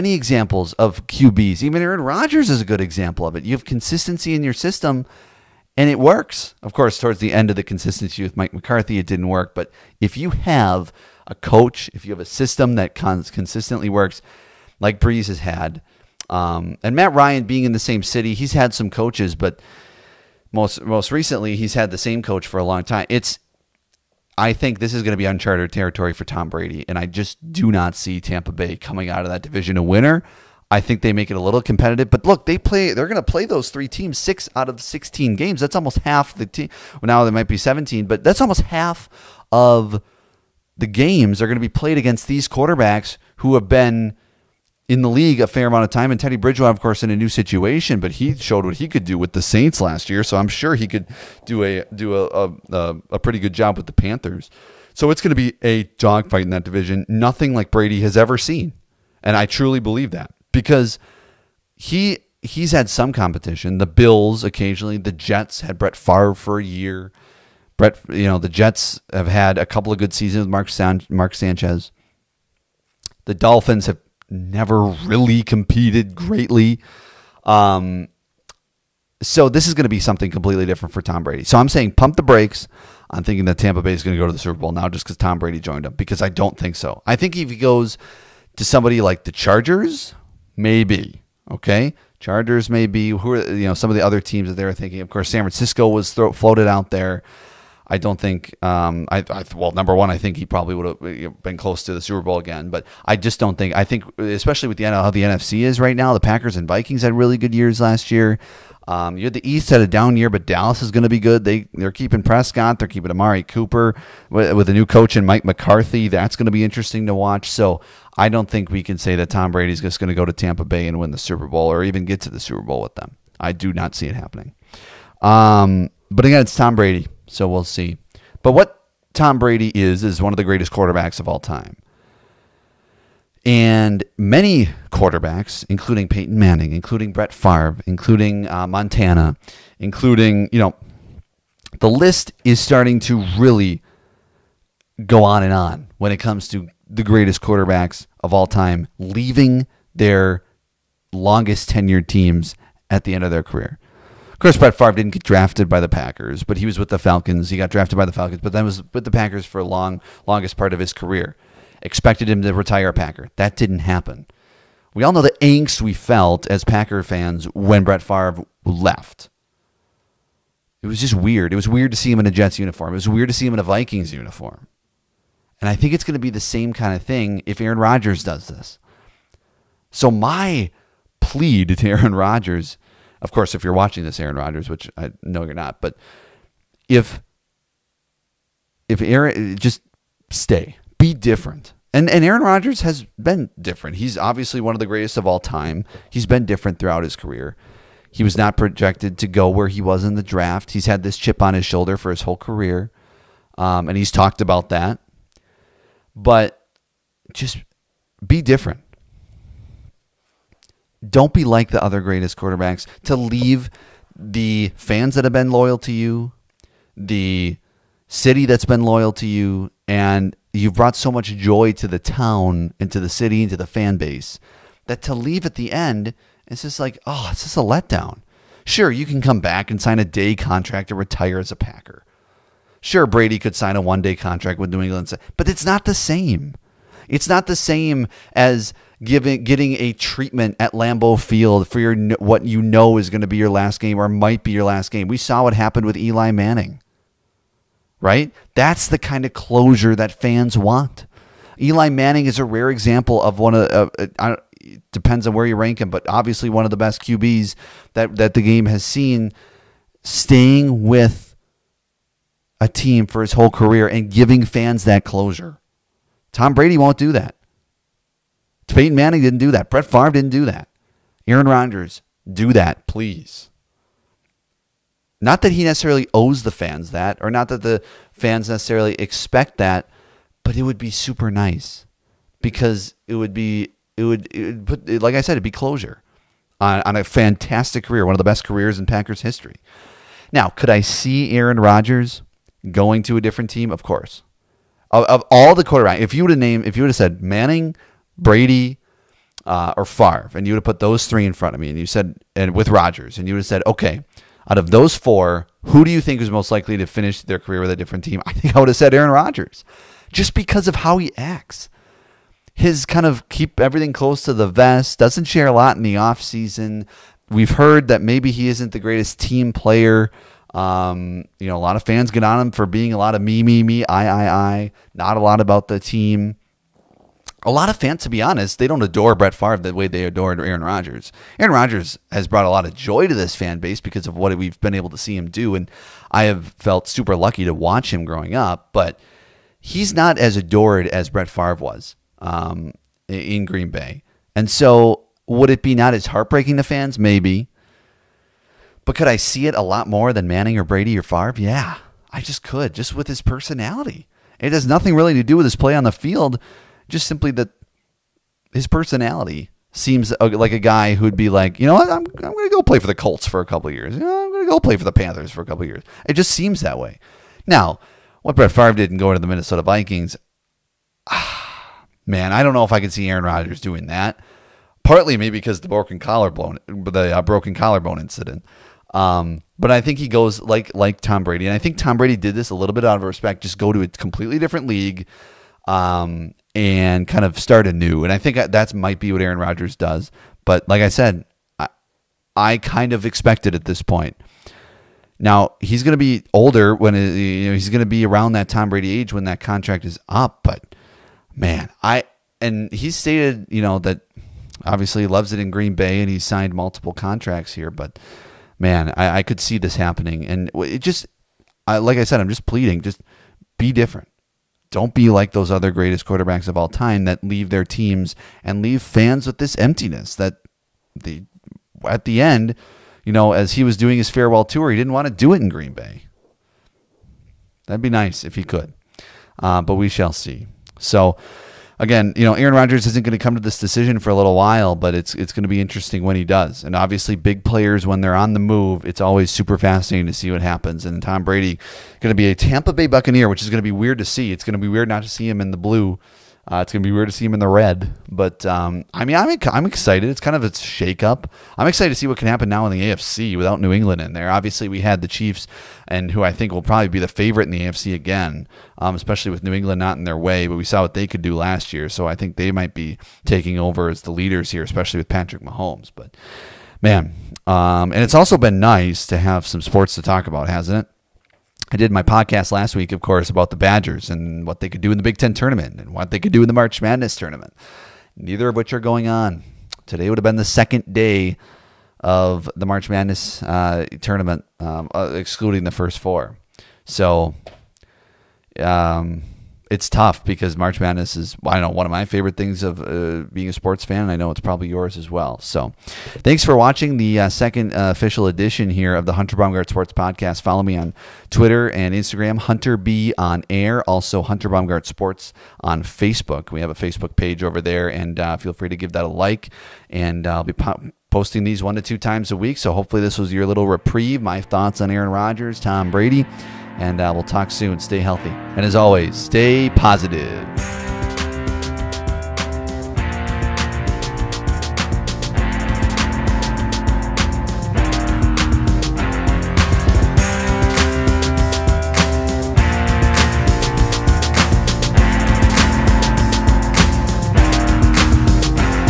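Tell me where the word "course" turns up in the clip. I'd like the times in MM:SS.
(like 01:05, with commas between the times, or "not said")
00:06, 00:46, 01:35, 02:34, 03:03, 04:53, 07:53.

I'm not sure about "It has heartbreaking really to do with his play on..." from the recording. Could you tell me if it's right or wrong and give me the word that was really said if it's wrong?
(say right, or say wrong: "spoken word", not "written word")
wrong: "nothing", not "heartbreaking".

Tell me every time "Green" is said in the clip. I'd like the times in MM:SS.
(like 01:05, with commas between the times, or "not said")
05:43, 06:45, 07:05.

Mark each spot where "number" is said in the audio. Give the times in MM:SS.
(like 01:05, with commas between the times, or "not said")
01:39.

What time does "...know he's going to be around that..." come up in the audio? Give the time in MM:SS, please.
06:37.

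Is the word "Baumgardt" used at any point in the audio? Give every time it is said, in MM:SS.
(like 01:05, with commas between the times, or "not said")
08:19, 08:24.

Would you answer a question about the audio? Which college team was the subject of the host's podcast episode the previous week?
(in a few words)
Badgers.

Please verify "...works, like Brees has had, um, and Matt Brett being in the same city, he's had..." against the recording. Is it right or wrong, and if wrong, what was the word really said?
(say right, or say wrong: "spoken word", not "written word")
wrong: "Ryan", not "Brett".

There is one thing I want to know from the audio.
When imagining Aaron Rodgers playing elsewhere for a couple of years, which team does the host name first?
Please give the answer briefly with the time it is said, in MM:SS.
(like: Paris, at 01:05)
Colts, at 06:02.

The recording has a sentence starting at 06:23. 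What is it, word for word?
Just go to a completely different league, um, and kind of start anew.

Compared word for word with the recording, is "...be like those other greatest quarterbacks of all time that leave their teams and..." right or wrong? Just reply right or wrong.
right.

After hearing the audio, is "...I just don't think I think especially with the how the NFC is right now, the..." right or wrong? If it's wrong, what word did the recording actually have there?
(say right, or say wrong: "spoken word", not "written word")
right.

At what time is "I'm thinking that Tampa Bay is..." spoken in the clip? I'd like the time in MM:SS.
01:23.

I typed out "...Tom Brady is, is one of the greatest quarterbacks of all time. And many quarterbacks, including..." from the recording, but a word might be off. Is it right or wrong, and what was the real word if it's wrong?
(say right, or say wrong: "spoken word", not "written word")
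right.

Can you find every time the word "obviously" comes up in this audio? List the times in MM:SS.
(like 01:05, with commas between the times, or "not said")
03:14, 04:16, 06:44, 07:16, 07:34.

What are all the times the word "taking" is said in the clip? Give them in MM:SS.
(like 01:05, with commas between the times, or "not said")
07:43.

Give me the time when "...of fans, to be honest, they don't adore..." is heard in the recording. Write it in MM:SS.
05:27.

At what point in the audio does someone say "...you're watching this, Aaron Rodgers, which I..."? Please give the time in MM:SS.
03:03.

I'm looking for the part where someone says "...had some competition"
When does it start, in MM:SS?
01:02.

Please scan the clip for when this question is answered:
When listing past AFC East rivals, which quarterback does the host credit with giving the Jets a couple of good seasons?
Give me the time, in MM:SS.
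01:11.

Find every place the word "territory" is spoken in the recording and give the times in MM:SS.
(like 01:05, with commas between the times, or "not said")
00:25.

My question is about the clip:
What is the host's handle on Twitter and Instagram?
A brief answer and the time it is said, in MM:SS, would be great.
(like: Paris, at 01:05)
Hunter B on Air, at 08:22.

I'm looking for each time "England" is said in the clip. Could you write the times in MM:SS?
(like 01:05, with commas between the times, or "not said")
03:54, 07:33, 07:39.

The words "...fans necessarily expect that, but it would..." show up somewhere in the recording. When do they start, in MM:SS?
04:38.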